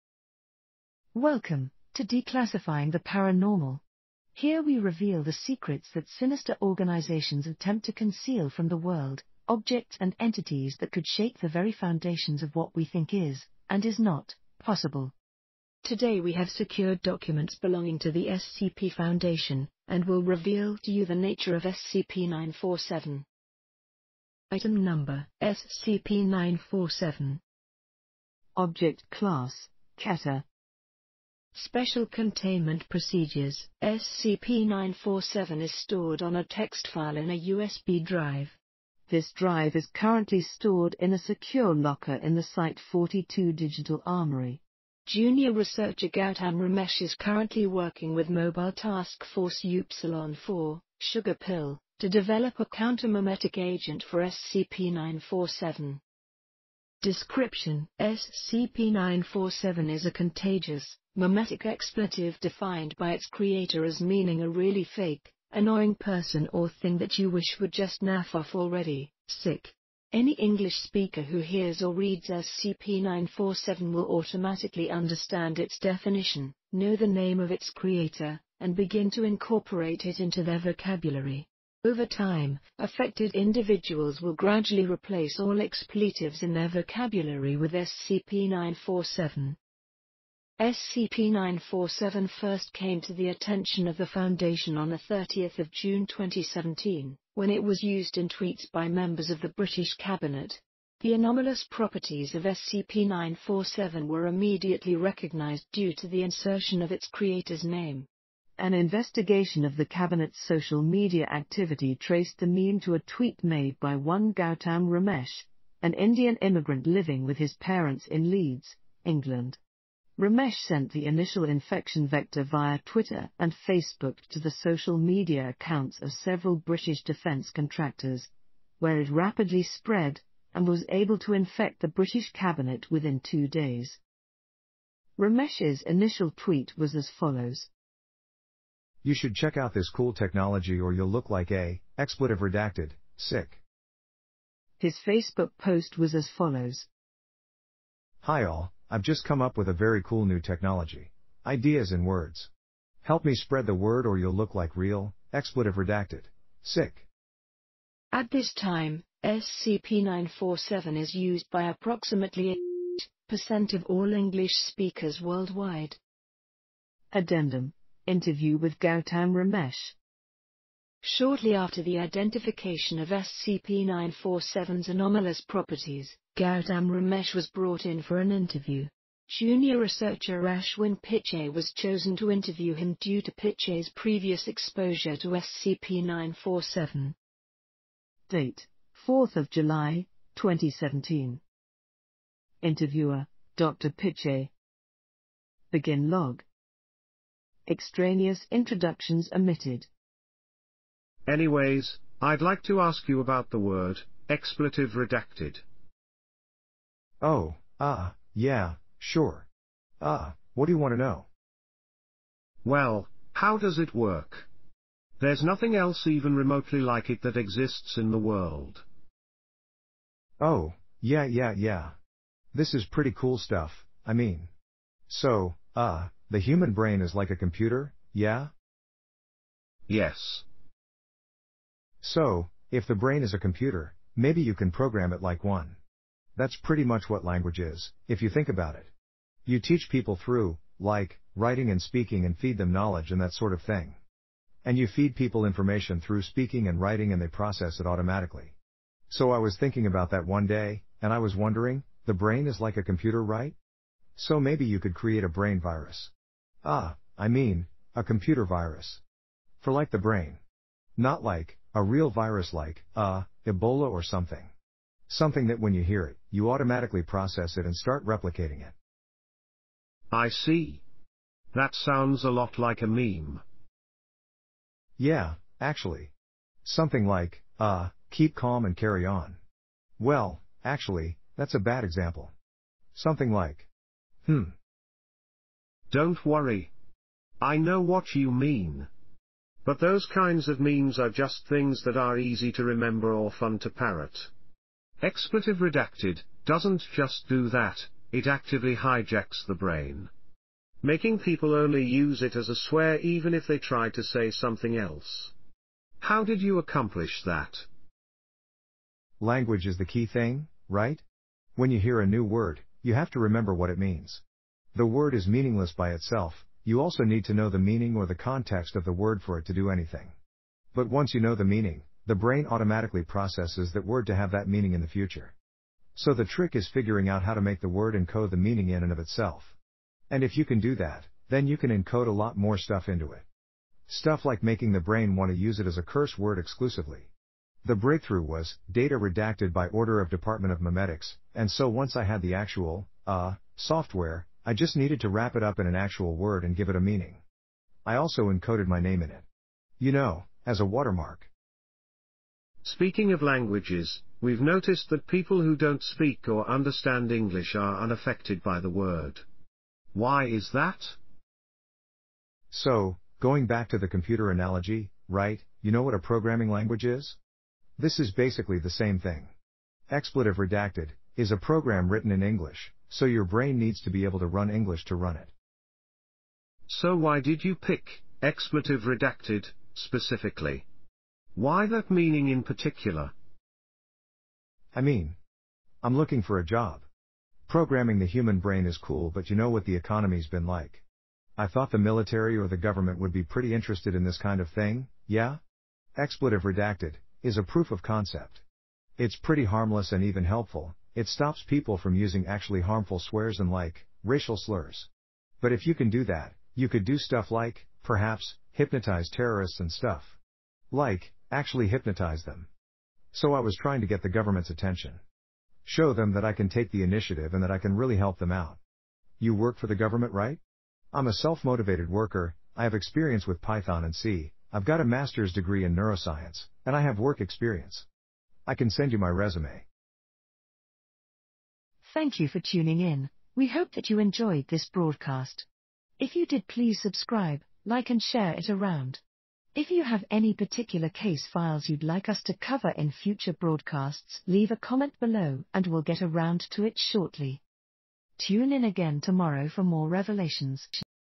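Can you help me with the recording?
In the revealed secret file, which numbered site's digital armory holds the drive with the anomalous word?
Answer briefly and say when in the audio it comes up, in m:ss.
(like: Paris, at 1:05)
Site 42, at 0:42.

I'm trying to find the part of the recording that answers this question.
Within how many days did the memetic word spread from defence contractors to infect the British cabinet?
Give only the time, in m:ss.
2:13.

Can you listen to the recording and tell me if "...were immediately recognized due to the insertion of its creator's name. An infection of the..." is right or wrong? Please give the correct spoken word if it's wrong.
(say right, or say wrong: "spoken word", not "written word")
wrong: "investigation", not "infection".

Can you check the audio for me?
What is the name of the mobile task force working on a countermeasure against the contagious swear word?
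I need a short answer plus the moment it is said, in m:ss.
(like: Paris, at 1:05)
Sugar Pill, at 0:51.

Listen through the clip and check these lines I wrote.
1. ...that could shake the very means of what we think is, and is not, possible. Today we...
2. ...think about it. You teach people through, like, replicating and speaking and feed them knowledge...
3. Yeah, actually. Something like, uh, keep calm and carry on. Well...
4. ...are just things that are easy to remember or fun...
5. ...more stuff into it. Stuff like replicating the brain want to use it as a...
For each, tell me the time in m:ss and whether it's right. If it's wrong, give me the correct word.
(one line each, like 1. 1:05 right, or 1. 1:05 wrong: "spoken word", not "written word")
1. 0:10 wrong: "foundations", not "means"
2. 3:58 wrong: "writing", not "replicating"
3. 4:34 right
4. 4:50 right
5. 5:32 wrong: "making", not "replicating".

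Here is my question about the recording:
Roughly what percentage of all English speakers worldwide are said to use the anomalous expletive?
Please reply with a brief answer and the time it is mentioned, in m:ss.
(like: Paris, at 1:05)
8%, at 2:43.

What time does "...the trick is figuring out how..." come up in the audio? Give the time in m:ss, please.
5:26.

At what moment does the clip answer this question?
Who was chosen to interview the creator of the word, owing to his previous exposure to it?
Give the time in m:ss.
3:00.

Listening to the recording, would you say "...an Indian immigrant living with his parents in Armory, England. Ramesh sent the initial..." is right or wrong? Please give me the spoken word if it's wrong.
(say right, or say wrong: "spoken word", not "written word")
wrong: "Leeds", not "Armory".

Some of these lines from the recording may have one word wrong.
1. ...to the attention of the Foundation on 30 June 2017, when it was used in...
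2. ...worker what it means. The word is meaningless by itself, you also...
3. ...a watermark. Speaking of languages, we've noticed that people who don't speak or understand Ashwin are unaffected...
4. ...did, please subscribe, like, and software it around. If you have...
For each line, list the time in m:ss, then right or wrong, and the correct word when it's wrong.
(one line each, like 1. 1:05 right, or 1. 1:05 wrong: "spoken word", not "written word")
1. 1:33 right
2. 5:13 wrong: "remember", not "worker"
3. 5:50 wrong: "English", not "Ashwin"
4. 7:16 wrong: "share", not "software".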